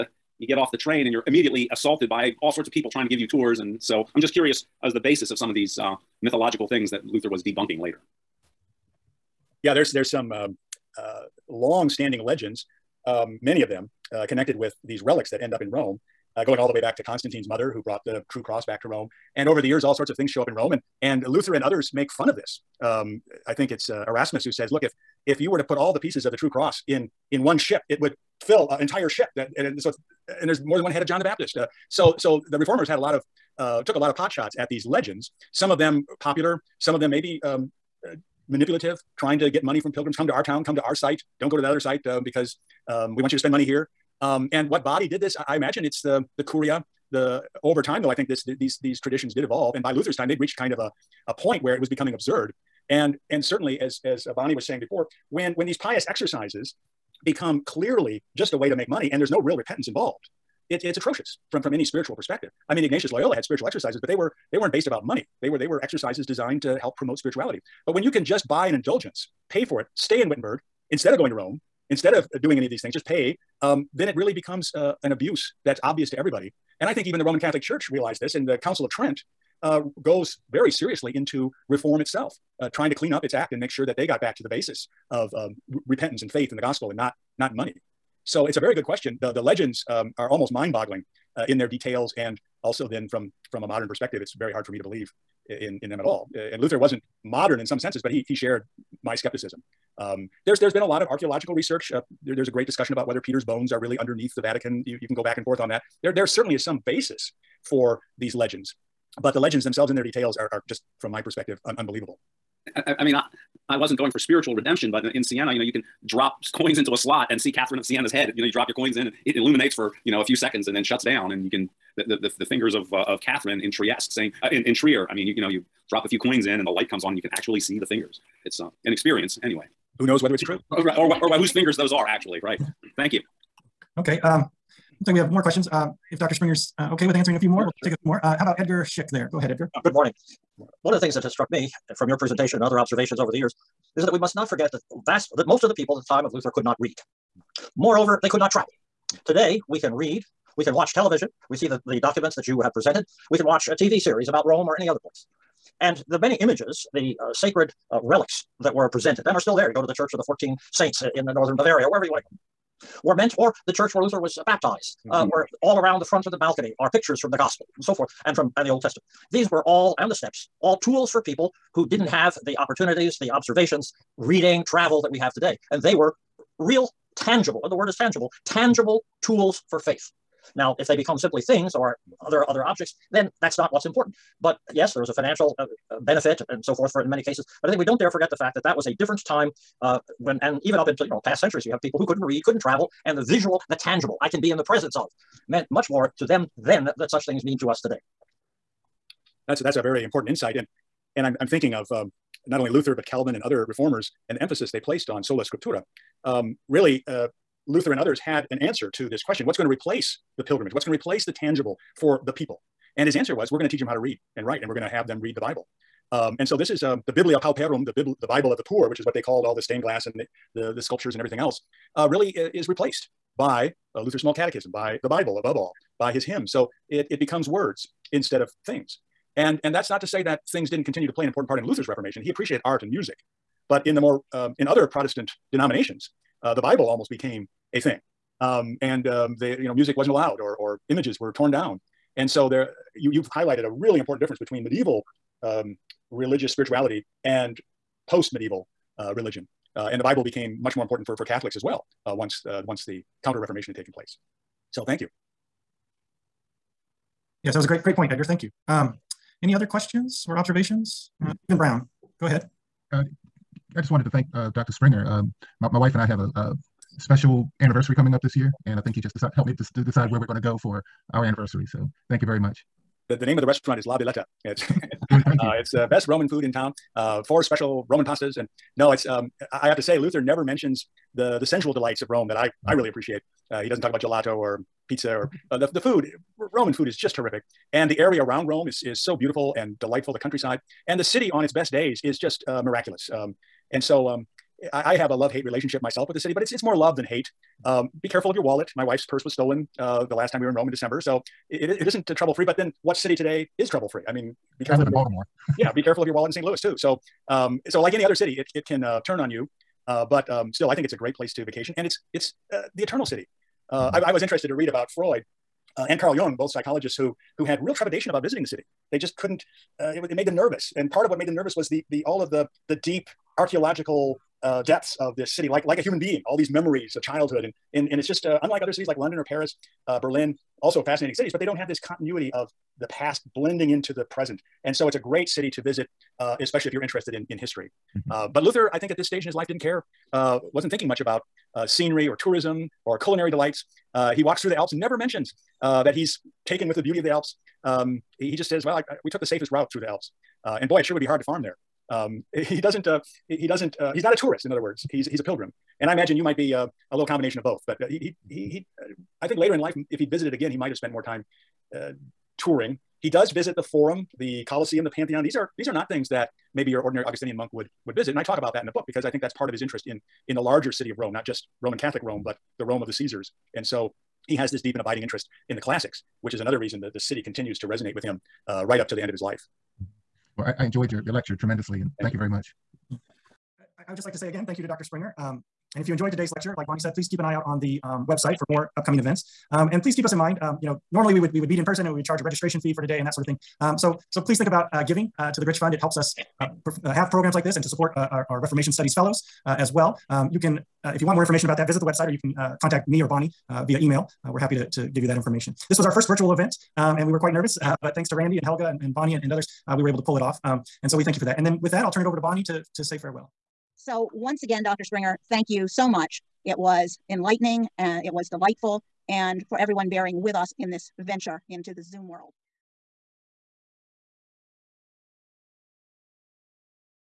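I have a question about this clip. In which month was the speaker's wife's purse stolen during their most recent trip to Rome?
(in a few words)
December.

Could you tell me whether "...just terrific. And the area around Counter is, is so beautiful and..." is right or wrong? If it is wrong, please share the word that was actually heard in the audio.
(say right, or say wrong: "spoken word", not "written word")
wrong: "Rome", not "Counter".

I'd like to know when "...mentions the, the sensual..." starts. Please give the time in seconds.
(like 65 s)
280 s.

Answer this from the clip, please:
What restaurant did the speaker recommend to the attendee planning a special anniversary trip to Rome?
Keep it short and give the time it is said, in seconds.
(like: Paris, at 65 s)
La Villetta, at 273 s.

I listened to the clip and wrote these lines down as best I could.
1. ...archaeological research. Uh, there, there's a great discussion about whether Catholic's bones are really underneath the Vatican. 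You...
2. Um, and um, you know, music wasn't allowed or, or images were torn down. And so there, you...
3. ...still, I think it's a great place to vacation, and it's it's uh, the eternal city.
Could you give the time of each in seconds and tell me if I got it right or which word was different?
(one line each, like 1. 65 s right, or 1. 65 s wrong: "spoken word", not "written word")
1. 101 s wrong: "Peter", not "Catholic"
2. 238 s right
3. 310 s right.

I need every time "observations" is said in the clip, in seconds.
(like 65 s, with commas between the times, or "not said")
142 s, 173 s, 260 s.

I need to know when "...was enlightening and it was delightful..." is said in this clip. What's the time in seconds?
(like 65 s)
416 s.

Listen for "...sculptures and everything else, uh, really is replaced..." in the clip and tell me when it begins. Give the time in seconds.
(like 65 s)
220 s.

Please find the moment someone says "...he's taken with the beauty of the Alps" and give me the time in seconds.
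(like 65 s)
345 s.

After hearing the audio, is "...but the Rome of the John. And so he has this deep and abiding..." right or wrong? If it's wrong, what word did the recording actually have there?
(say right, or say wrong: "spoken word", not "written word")
wrong: "Caesars", not "John".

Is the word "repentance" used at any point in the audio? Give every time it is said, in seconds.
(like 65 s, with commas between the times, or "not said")
59 s, 85 s.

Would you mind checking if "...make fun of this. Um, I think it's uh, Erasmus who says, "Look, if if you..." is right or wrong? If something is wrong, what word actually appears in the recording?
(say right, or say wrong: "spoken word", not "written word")
right.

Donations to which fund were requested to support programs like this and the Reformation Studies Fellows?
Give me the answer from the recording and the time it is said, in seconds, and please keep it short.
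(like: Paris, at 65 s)
Gritsch Fund, at 395 s.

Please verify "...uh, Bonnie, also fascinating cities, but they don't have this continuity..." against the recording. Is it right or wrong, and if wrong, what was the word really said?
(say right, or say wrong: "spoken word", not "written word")
wrong: "Berlin", not "Bonnie".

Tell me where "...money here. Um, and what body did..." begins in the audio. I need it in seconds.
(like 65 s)
43 s.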